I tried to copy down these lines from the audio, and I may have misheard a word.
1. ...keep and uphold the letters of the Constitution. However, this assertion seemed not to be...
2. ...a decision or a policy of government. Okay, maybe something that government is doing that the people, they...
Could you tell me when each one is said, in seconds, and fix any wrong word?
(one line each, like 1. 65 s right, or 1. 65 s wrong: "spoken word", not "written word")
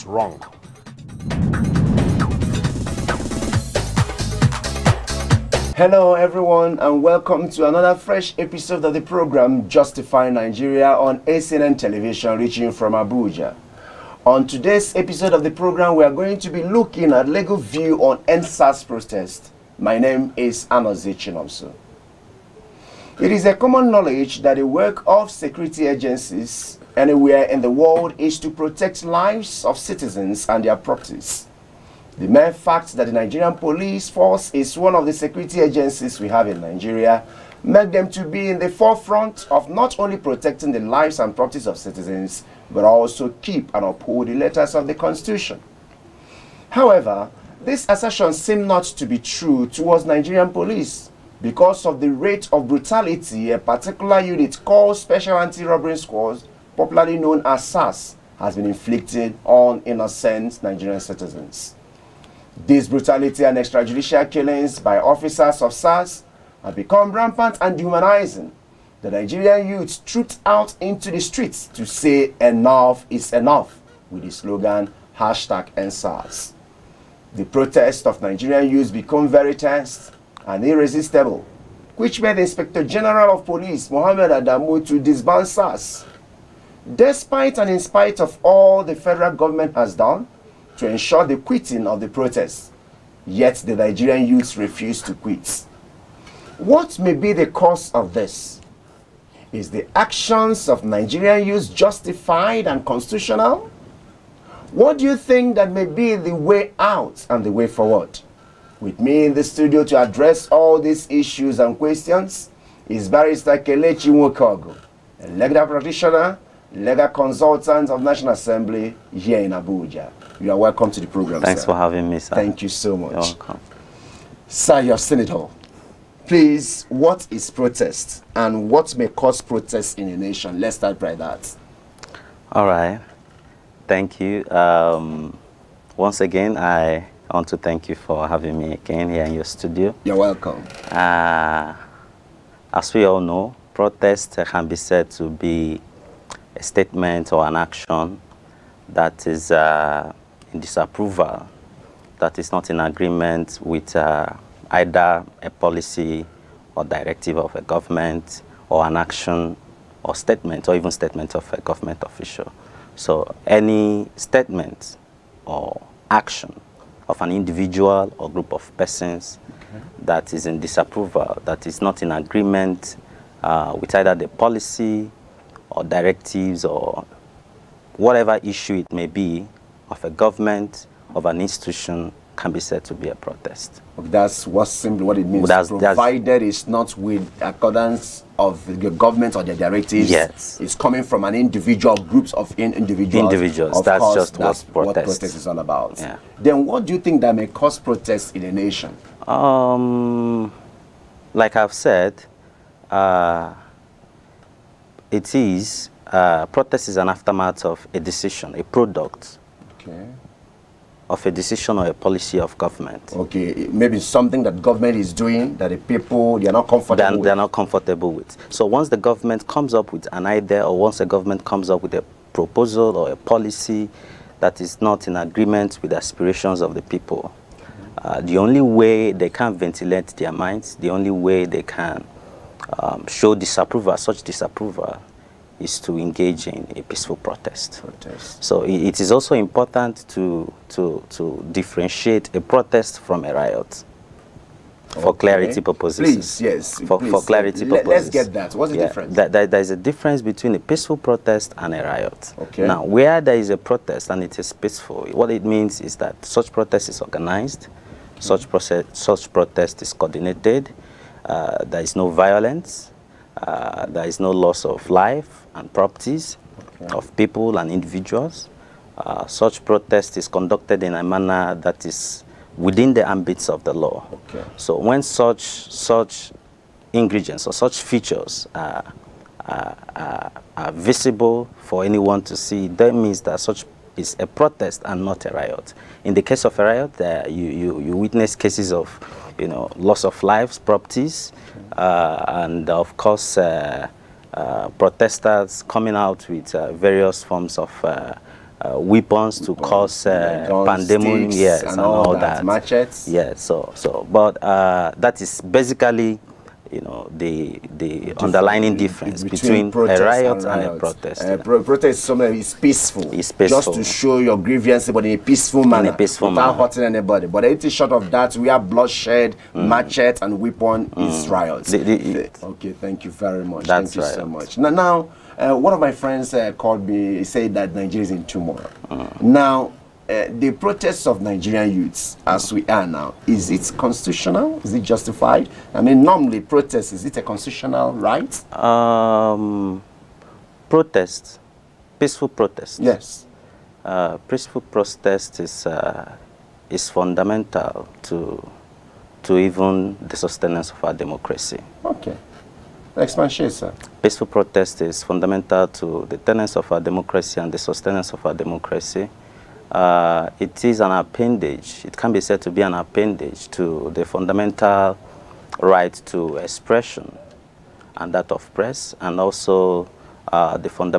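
1. 43 s right
2. 211 s right.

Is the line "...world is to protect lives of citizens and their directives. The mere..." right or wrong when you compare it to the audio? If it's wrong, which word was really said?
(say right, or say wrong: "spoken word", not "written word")
wrong: "properties", not "directives".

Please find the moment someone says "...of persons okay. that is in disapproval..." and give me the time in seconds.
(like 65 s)
168 s.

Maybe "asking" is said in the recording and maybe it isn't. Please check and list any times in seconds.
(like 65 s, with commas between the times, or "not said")
not said.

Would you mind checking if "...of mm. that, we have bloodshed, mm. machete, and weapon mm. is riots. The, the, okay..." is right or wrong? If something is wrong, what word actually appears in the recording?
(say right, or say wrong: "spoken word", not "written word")
right.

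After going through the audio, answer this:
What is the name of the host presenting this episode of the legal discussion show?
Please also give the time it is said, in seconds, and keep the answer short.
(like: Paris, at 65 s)
Anna Chinomso, at 20 s.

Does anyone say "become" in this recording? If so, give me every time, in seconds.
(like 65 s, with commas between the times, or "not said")
66 s, 78 s.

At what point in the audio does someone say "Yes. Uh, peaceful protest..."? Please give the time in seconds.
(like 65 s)
342 s.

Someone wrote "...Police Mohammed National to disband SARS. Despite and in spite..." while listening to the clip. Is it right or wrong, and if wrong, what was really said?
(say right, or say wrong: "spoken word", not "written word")
wrong: "Adamu", not "National".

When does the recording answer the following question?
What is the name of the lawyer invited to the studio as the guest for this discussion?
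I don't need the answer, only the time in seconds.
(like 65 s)
113 s.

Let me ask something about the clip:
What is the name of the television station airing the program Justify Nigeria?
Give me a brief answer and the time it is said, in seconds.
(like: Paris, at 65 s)
ACNN, at 11 s.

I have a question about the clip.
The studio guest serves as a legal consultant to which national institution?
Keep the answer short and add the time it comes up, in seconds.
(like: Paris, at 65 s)
National Assembly, at 118 s.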